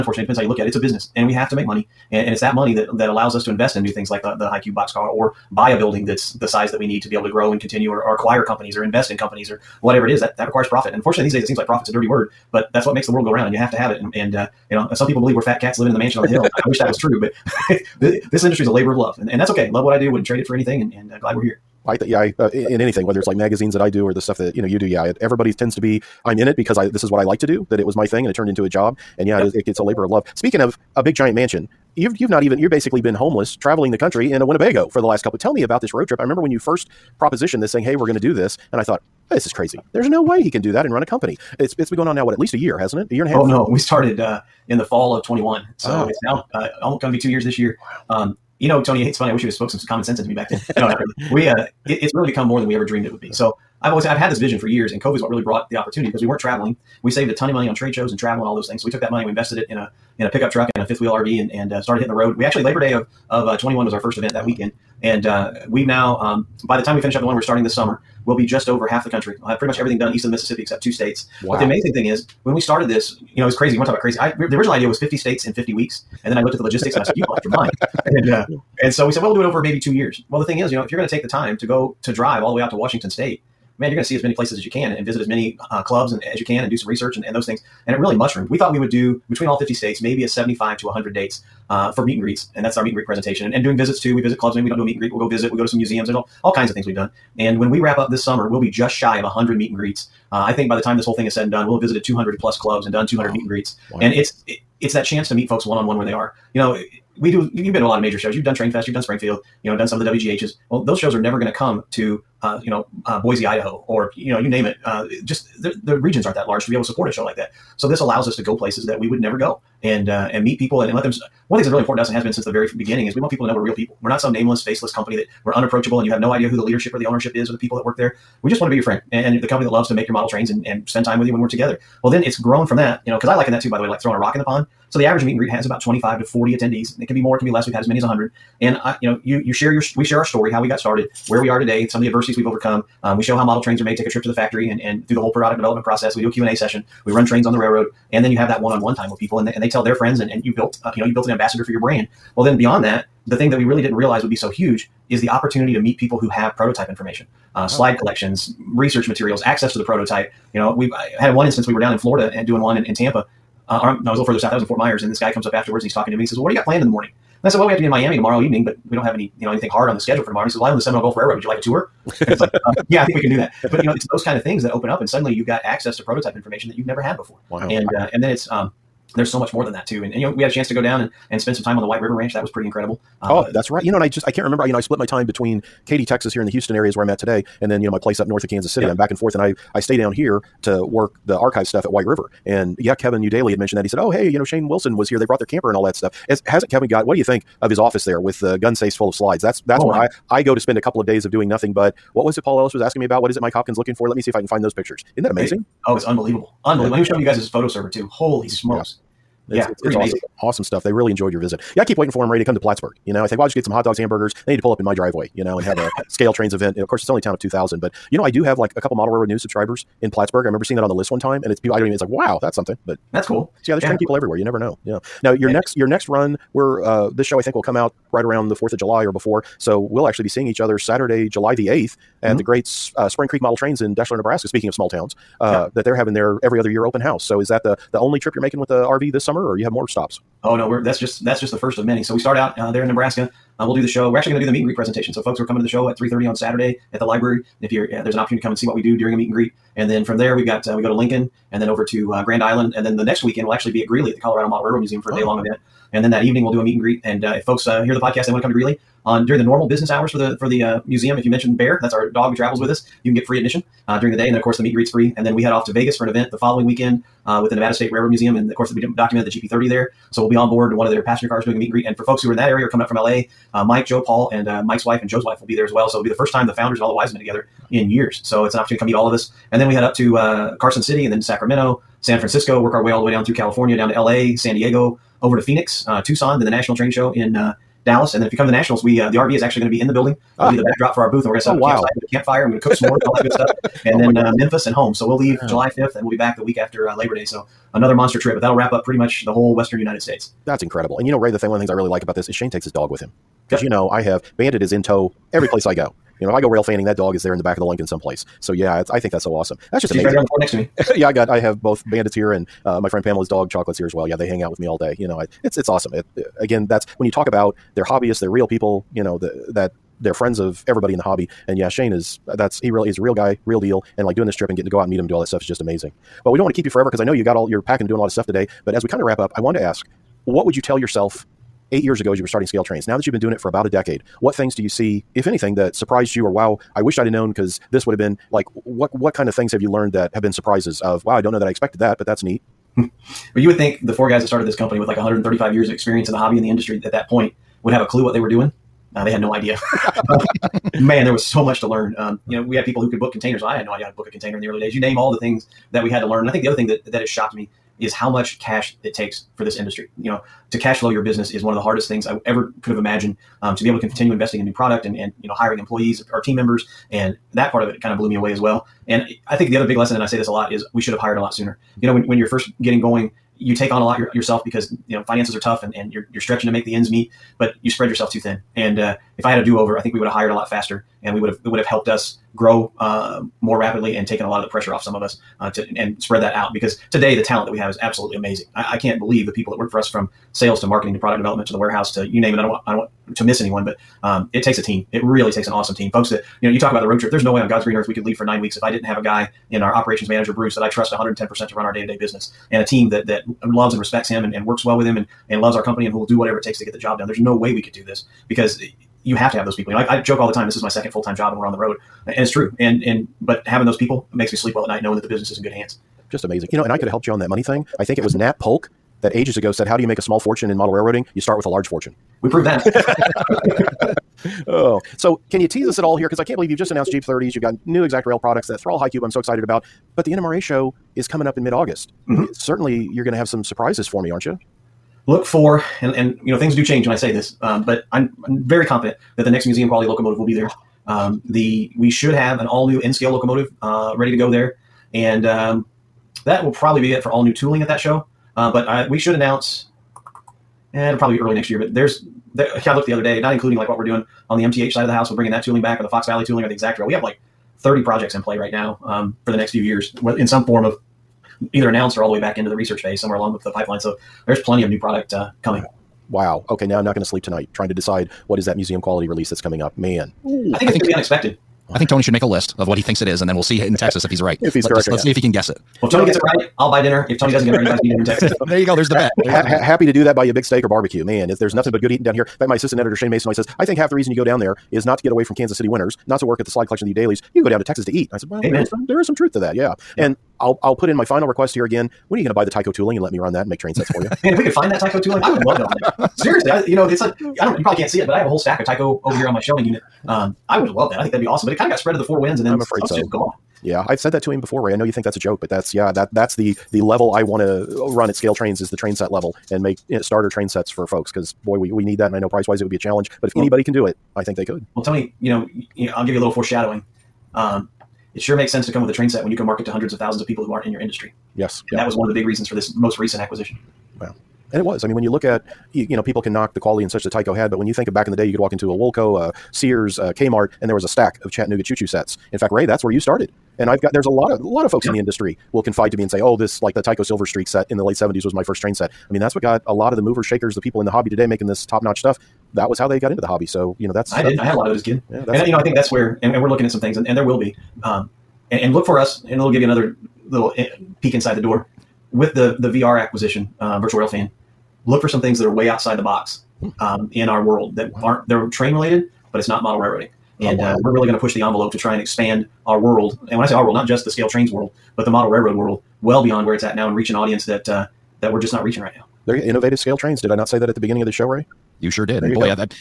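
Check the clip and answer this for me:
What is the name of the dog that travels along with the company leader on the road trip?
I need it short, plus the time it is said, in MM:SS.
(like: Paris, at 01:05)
Bear, at 04:21.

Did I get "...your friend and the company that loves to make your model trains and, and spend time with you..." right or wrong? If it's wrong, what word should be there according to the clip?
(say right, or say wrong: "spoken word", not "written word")
right.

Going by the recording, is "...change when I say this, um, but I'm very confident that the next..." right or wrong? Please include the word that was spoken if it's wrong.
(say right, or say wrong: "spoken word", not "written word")
right.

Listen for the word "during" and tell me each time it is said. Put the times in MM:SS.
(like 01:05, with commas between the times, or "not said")
04:08, 04:19, 04:23.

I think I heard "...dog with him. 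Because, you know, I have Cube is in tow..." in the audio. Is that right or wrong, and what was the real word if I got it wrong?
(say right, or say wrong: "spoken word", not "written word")
wrong: "Bandit", not "Cube".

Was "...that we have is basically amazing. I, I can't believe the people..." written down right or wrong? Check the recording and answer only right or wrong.
wrong.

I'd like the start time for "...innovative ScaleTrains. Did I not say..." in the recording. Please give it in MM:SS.
09:29.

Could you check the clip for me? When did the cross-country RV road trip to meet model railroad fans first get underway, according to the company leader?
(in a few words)
Fall of 2021.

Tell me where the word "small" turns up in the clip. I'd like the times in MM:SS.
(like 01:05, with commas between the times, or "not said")
03:54, 07:00.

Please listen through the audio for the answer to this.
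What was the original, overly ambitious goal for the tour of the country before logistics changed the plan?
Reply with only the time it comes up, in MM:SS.
01:14.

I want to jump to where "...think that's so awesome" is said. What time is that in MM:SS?
05:08.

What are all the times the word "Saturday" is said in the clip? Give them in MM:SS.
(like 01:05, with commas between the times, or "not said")
03:50, 04:06.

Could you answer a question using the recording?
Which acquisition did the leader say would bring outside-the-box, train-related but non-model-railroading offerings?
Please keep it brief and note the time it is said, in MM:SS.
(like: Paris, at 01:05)
Virtual Rail Fan, at 09:13.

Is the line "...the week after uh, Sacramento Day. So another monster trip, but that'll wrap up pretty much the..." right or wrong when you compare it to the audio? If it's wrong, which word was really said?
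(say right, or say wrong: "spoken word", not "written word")
wrong: "Labor", not "Sacramento".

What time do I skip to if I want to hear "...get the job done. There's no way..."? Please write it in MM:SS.
06:46.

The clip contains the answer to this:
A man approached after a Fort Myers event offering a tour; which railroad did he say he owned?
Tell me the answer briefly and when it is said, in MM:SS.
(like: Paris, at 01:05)
Seminole Gulf Railroad, at 02:50.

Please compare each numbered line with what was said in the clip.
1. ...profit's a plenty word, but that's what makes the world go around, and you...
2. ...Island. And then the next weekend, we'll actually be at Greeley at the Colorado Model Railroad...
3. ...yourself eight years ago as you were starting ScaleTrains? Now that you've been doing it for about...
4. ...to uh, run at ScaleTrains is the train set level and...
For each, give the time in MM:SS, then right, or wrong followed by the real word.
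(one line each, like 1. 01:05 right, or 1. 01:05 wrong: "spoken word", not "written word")
1. 00:11 wrong: "dirty", not "plenty"
2. 04:12 right
3. 05:30 right
4. 08:27 right.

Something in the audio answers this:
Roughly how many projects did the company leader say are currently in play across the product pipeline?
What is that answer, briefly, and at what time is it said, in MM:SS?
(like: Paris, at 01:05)
30, at 07:37.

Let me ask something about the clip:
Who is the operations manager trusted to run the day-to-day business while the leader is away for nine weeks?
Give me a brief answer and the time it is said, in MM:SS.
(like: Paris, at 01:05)
Bruce, at 06:40.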